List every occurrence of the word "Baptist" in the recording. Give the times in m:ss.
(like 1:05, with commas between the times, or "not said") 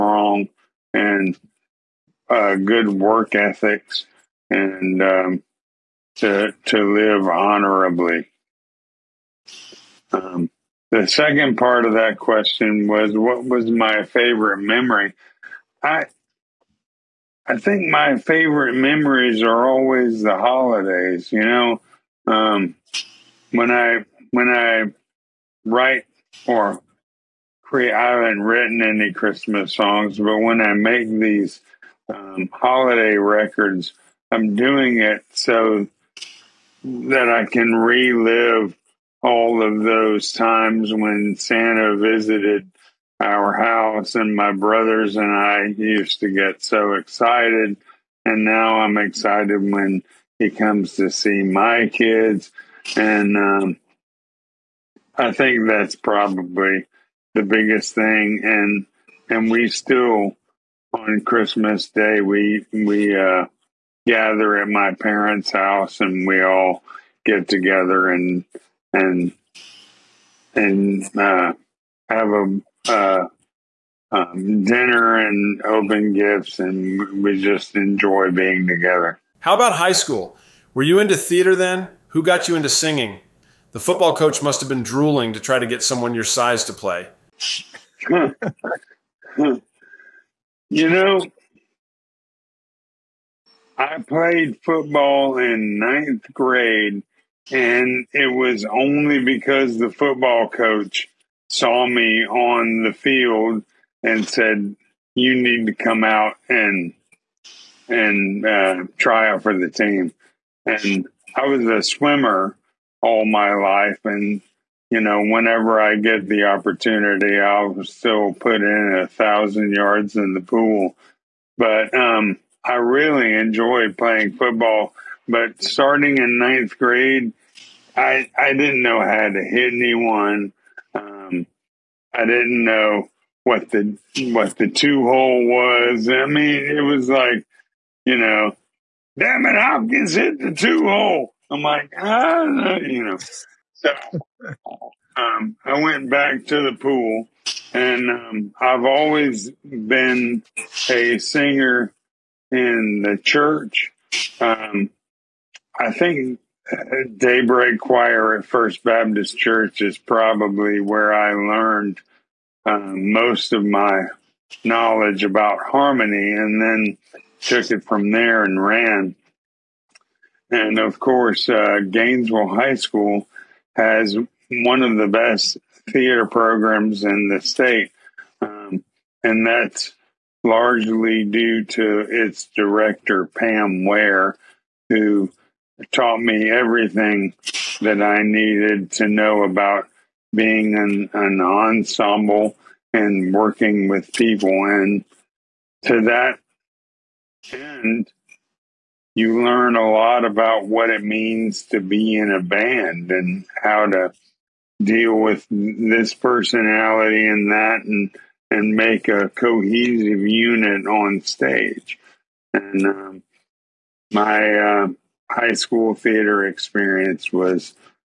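2:38.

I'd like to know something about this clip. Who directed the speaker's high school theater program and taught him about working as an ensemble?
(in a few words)
Pam Ware.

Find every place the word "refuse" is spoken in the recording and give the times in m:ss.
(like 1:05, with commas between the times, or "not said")
not said.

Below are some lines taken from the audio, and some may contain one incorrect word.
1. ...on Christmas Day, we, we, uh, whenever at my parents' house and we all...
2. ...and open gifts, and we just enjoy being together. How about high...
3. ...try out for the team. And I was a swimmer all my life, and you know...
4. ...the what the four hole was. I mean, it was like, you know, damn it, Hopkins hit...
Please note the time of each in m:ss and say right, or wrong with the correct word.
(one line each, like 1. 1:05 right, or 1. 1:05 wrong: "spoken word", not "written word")
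1. 1:00 wrong: "gather", not "whenever"
2. 1:15 right
3. 1:48 right
4. 2:13 wrong: "two", not "four".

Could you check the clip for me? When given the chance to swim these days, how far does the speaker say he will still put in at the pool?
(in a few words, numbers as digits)
1000 yards.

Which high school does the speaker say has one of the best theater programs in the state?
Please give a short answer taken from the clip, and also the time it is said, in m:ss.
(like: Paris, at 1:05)
Gainesville High School, at 2:51.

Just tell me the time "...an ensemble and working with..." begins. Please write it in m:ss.
3:11.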